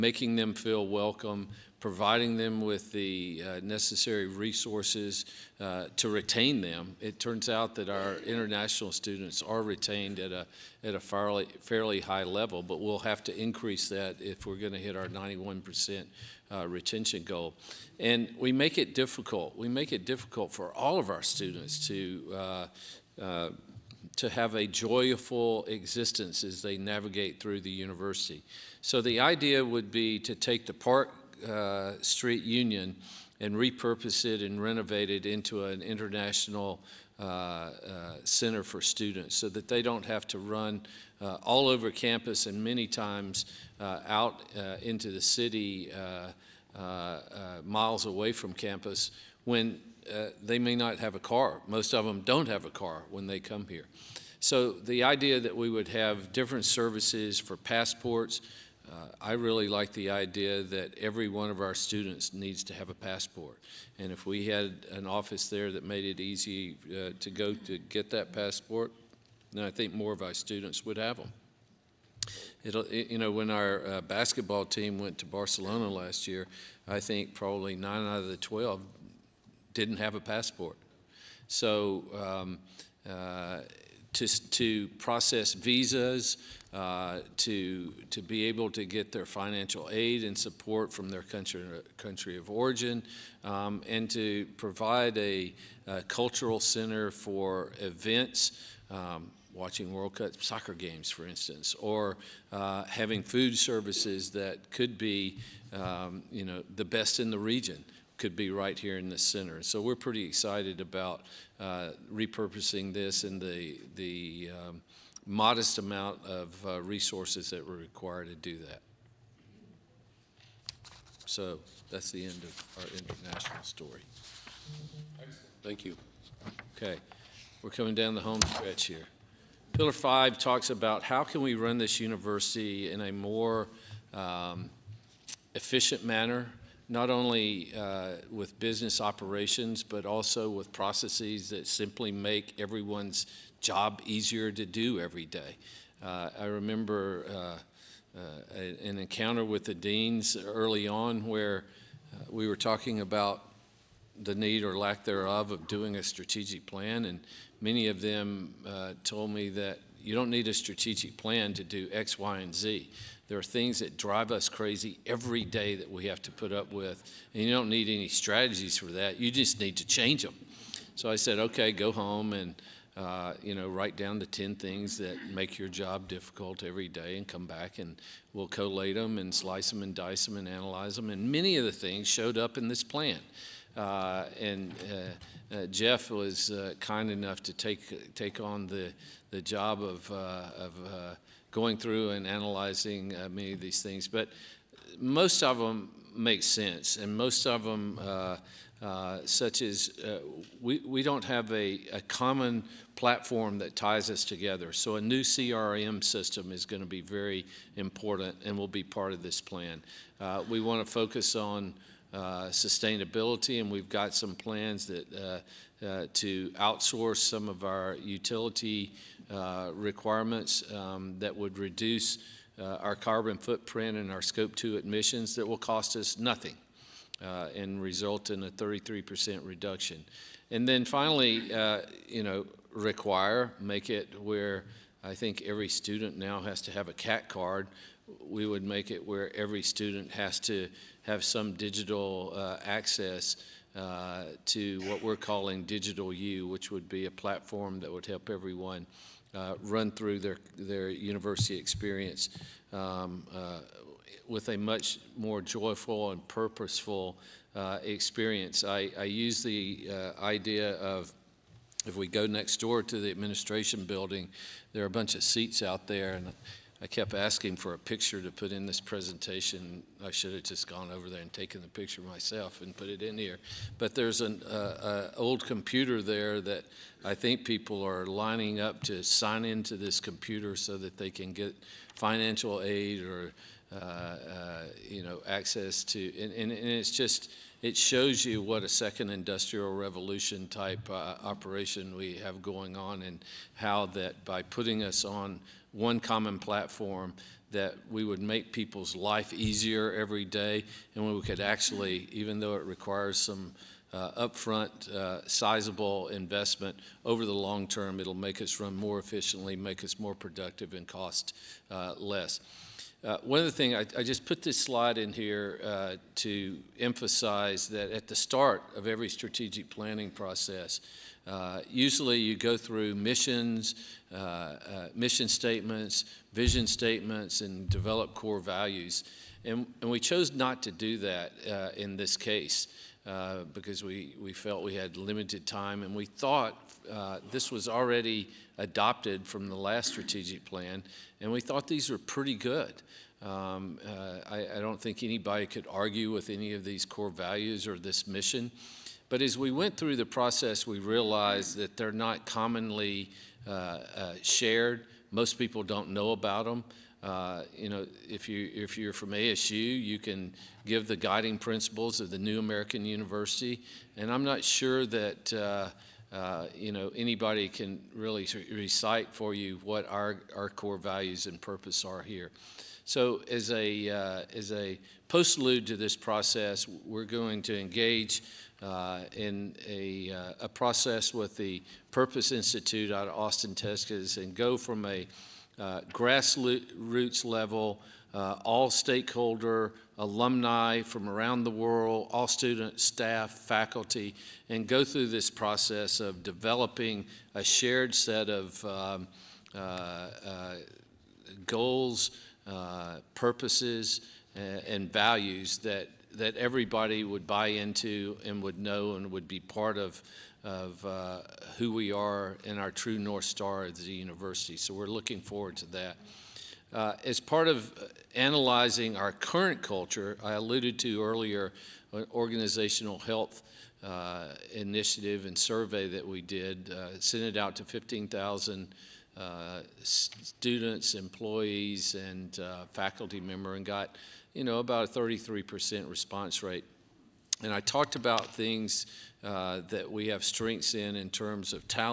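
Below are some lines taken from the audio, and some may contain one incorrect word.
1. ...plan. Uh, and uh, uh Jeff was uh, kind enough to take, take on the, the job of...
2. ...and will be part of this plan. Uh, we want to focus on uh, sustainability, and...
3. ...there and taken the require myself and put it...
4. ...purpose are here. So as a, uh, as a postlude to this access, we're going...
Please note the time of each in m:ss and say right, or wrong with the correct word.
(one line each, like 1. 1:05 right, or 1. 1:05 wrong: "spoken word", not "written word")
1. 3:02 right
2. 3:28 right
3. 4:31 wrong: "picture", not "require"
4. 6:11 wrong: "process", not "access".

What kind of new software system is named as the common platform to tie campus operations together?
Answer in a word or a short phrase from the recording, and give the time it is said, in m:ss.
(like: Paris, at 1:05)
CRM system, at 3:25.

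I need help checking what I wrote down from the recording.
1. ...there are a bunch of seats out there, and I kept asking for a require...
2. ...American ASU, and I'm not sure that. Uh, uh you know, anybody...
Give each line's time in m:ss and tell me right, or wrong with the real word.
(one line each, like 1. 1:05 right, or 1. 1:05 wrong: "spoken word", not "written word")
1. 4:24 wrong: "picture", not "require"
2. 6:02 wrong: "University", not "ASU".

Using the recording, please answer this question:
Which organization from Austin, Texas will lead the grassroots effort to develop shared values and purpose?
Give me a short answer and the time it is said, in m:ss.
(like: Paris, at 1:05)
Purpose Institute, at 6:21.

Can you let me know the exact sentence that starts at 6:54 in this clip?
So we're looking forward to that.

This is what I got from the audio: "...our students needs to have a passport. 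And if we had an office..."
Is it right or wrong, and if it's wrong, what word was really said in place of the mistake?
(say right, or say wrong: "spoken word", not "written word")
right.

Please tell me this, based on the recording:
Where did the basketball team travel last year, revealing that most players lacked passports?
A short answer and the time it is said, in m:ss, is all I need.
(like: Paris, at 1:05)
Barcelona, at 1:15.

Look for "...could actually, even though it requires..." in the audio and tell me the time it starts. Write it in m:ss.
5:01.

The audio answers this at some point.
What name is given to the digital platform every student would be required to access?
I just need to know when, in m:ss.
4:05.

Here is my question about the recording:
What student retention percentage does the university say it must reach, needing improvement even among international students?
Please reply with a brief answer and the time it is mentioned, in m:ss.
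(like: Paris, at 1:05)
91%, at 0:15.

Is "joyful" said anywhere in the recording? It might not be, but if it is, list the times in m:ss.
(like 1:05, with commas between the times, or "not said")
0:24, 4:15.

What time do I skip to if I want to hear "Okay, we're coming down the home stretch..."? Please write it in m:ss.
2:06.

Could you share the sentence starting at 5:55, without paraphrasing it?
Most people don't know about them.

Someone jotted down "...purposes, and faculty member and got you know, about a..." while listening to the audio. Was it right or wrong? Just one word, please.
wrong.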